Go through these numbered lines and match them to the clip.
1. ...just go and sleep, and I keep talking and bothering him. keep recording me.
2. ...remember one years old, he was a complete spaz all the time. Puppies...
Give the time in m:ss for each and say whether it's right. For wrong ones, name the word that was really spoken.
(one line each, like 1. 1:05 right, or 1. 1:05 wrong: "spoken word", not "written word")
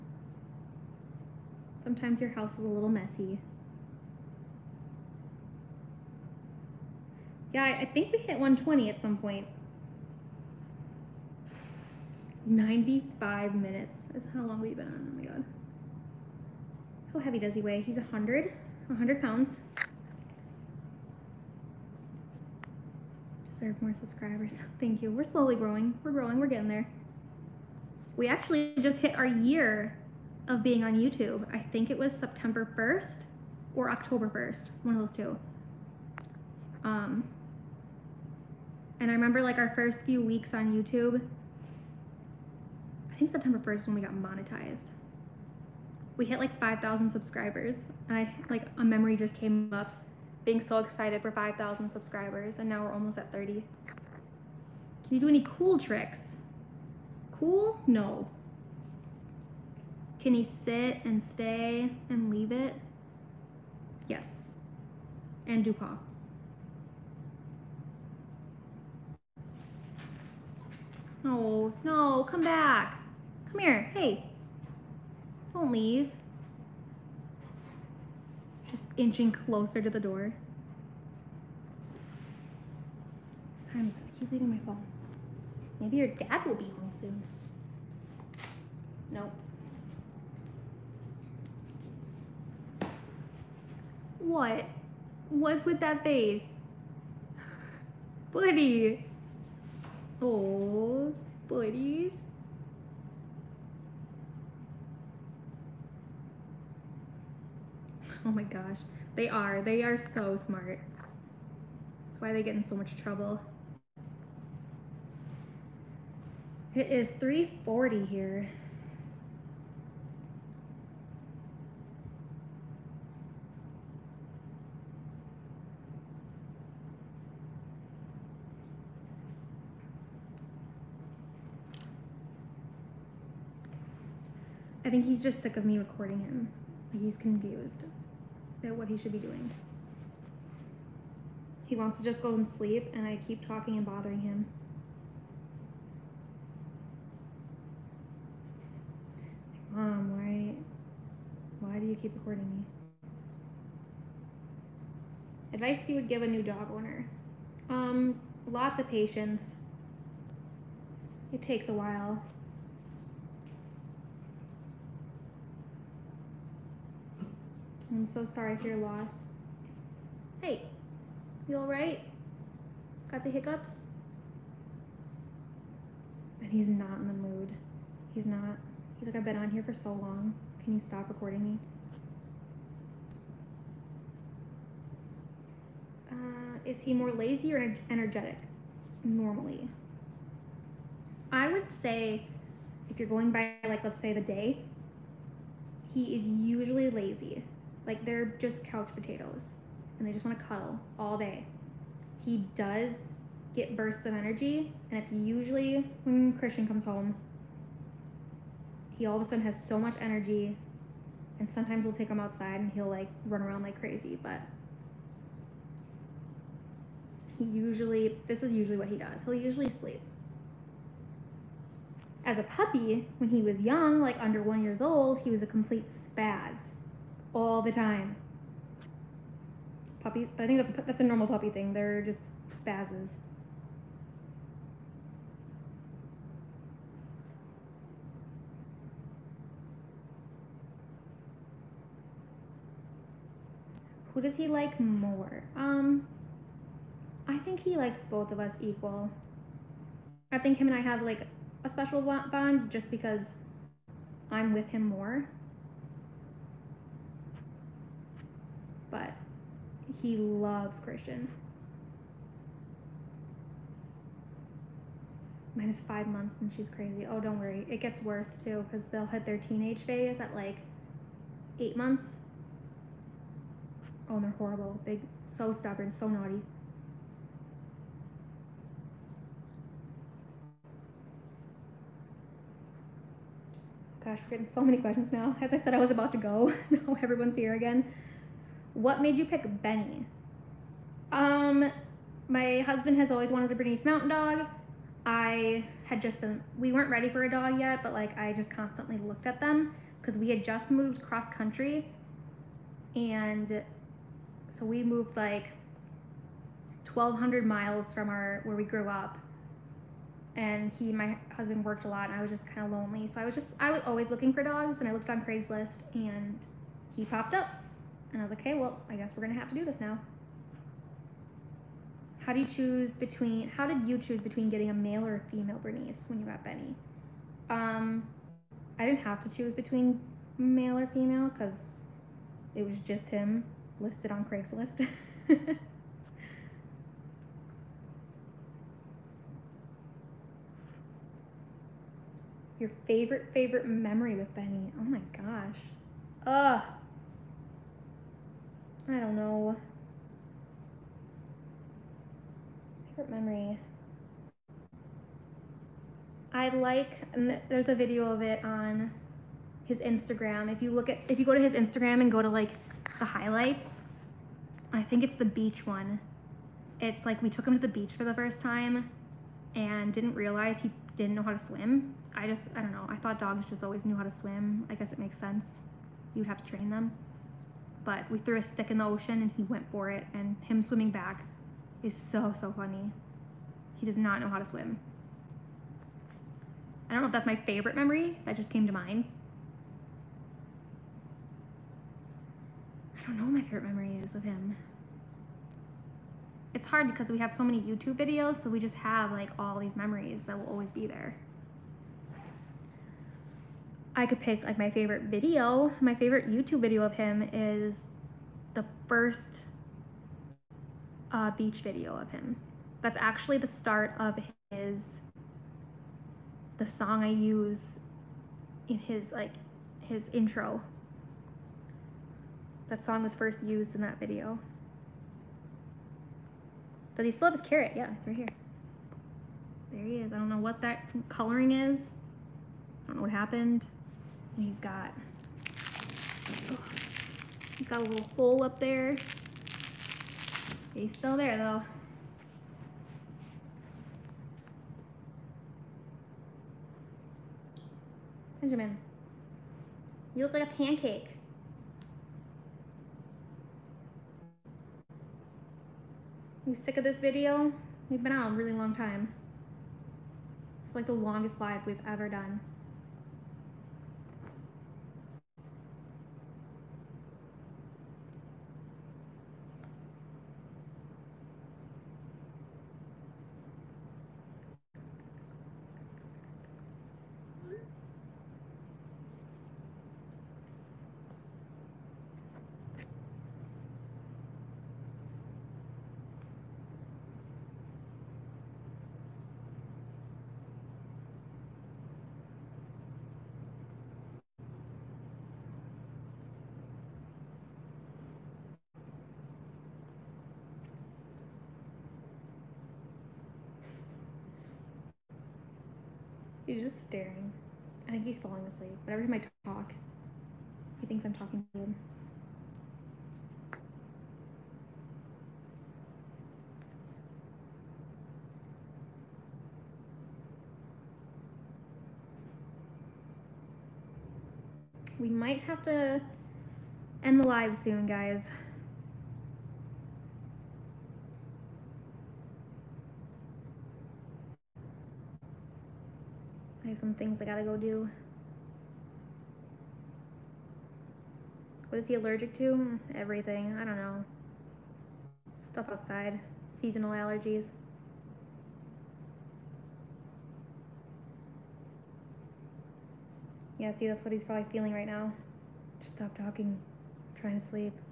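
1. 2:22 right
2. 3:44 wrong: "under", not "remember".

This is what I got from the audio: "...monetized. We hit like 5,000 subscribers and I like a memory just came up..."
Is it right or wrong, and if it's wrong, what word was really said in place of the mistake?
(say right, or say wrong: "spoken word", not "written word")
right.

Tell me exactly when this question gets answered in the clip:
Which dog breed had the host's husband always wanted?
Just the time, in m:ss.
4:53.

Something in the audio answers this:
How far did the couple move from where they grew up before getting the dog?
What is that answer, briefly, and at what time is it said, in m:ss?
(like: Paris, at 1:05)
1,200 miles, at 5:06.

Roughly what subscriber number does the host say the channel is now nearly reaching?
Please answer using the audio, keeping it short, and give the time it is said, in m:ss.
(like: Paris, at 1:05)
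30,000, at 0:52.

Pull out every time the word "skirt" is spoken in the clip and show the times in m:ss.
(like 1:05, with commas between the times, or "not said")
not said.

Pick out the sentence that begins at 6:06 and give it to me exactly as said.
It's like we took him to the beach for the first time and didn't realize he didn't know how to swim.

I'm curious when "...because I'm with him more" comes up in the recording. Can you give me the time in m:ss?
4:12.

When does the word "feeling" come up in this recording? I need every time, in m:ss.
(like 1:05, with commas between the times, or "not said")
9:14.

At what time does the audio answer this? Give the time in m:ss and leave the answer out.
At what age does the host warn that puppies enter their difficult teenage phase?
4:31.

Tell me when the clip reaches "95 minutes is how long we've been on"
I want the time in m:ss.
0:12.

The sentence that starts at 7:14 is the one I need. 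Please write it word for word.
And he's got, oh, he's got a little hole up there.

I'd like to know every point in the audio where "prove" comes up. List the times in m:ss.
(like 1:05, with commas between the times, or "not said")
not said.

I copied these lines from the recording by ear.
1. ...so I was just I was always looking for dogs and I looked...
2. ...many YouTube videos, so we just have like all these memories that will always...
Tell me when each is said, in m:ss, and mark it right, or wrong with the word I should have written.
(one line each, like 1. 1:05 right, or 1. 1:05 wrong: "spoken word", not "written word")
1. 5:13 right
2. 6:37 right.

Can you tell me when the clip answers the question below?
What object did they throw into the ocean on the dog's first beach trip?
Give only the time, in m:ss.
6:18.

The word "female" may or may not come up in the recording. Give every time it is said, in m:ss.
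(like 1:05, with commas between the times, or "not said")
5:25, 5:30.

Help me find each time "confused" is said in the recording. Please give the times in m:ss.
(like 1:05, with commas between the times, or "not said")
2:17.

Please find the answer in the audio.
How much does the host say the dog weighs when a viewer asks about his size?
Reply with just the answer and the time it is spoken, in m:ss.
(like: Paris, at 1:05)
100 pounds, at 0:17.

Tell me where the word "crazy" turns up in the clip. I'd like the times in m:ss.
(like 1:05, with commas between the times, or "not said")
3:33, 4:26.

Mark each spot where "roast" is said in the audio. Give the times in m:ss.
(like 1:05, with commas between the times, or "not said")
not said.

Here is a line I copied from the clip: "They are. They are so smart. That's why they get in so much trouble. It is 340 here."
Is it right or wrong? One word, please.
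right.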